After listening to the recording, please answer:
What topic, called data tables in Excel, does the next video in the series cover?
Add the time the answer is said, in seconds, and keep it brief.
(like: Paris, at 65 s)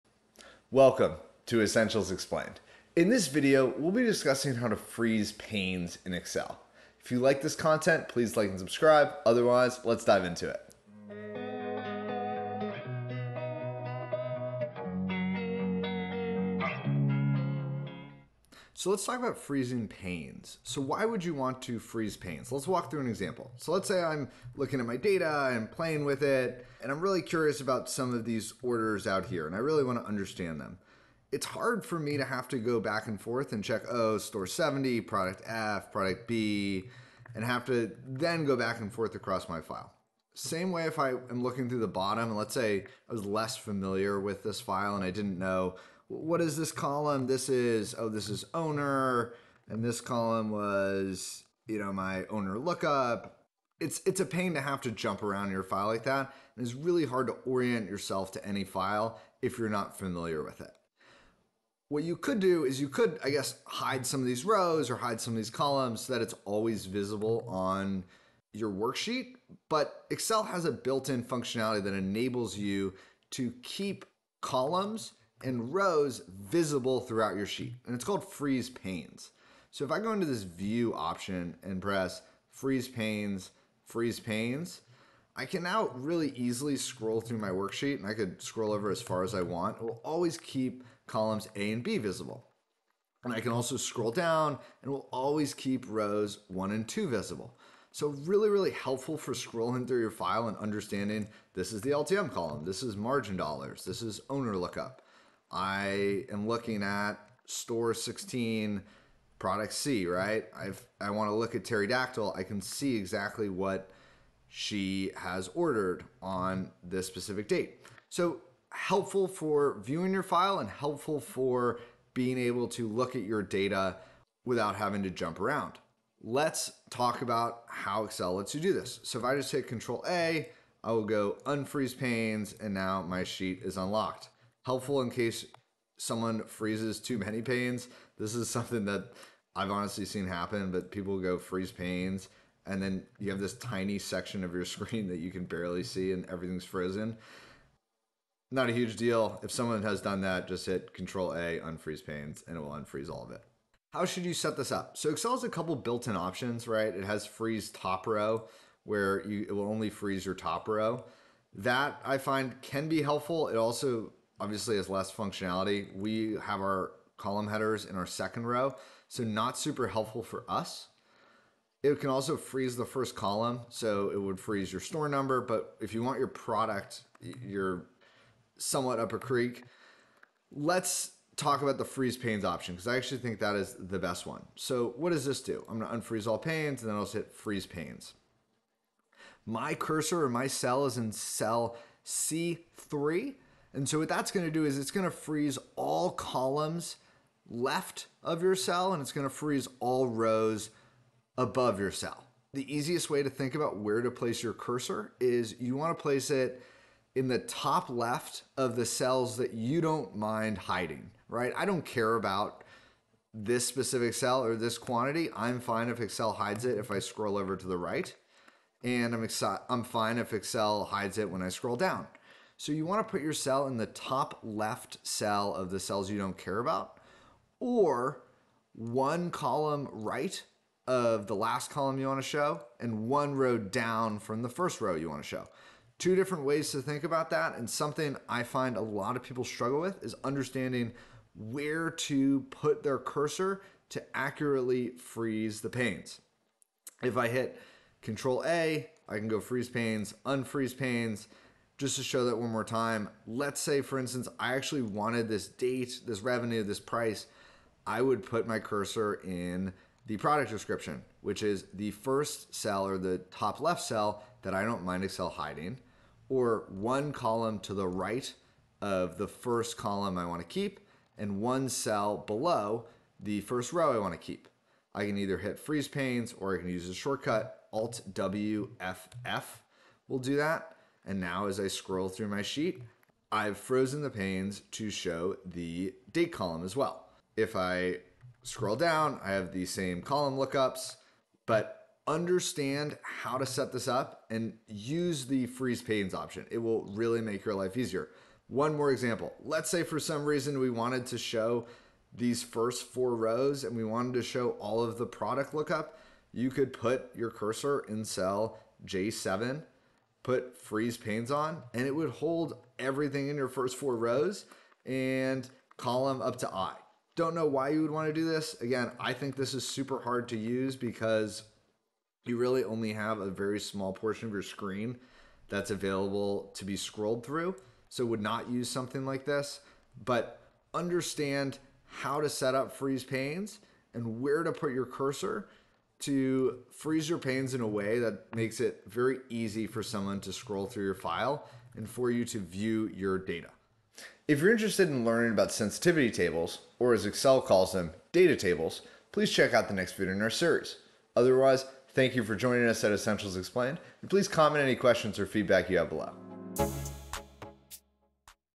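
Sensitivity tables, at 345 s.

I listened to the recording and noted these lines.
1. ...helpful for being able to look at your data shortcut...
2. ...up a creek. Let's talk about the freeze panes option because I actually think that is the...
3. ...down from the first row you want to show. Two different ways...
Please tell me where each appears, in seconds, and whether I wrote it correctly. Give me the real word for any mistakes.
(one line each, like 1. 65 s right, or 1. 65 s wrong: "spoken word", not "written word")
1. 120 s wrong: "without", not "shortcut"
2. 178 s right
3. 233 s right.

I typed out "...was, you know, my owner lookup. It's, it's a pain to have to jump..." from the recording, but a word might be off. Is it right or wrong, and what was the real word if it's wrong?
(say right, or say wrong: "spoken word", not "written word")
right.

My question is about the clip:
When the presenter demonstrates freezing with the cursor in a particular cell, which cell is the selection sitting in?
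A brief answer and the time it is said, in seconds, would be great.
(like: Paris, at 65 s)
C3, at 192 s.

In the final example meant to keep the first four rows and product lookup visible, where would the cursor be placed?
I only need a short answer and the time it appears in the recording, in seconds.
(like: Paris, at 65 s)
J7, at 308 s.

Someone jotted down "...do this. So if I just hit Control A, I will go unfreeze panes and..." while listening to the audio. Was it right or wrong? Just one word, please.
right.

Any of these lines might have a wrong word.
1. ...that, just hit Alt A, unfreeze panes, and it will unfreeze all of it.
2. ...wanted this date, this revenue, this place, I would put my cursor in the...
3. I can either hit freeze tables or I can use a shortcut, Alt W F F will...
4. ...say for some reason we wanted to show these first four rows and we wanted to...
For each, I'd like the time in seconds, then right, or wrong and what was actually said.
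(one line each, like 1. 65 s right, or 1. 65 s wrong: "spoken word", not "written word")
1. 150 s wrong: "Control", not "Alt"
2. 254 s wrong: "price", not "place"
3. 274 s wrong: "panes", not "tables"
4. 299 s right.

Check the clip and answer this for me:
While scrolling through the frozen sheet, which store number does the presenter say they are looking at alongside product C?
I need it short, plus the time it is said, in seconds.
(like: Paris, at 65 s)
16, at 107 s.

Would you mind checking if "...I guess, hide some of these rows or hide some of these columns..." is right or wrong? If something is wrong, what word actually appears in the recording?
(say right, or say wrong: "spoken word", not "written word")
right.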